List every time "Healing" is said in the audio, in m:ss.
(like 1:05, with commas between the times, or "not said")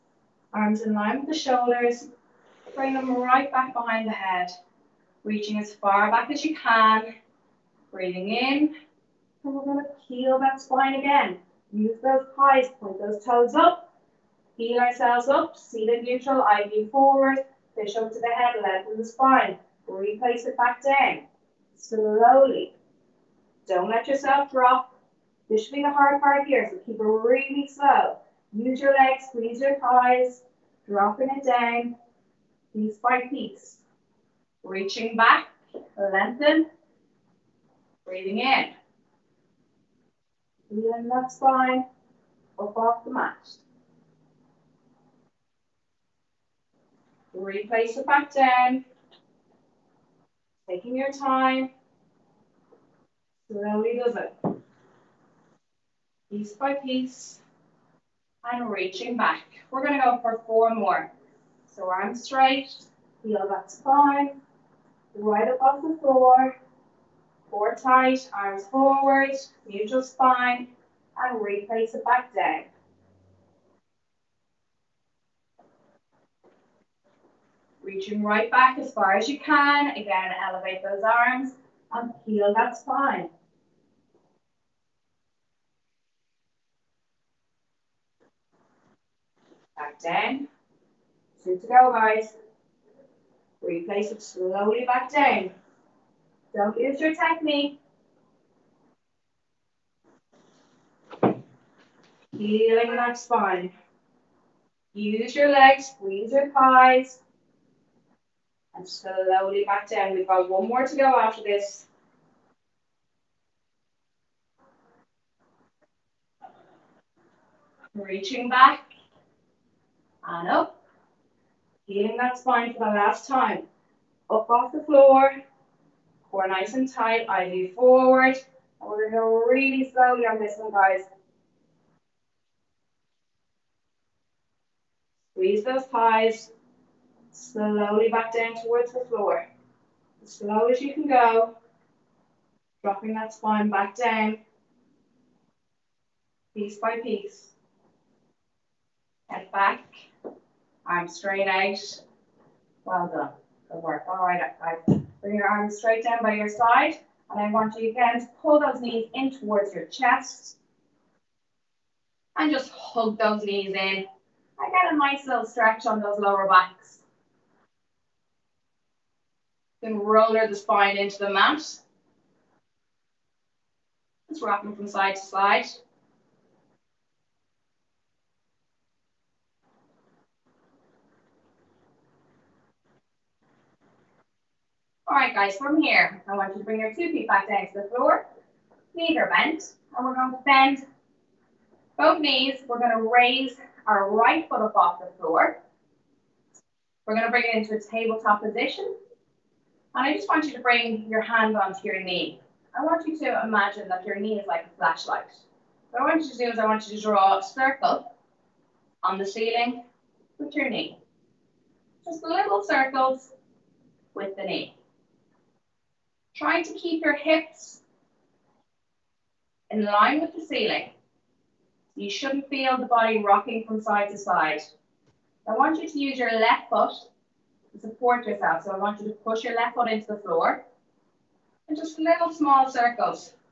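1:42, 2:01.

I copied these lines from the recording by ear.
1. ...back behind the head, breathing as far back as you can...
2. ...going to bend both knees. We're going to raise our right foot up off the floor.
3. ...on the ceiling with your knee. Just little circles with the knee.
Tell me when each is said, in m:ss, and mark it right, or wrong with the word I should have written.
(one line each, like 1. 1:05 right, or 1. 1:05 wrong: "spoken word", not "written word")
1. 0:03 wrong: "reaching", not "breathing"
2. 3:10 right
3. 3:29 right.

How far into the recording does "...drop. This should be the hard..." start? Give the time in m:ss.
0:24.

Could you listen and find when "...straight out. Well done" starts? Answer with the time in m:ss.
2:31.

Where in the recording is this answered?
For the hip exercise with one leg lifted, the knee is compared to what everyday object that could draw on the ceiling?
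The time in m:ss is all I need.
3:24.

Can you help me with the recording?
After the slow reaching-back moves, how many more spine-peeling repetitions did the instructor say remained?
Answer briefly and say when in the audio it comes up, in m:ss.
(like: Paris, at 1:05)
4, at 1:00.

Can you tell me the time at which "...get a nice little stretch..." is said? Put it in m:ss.
2:44.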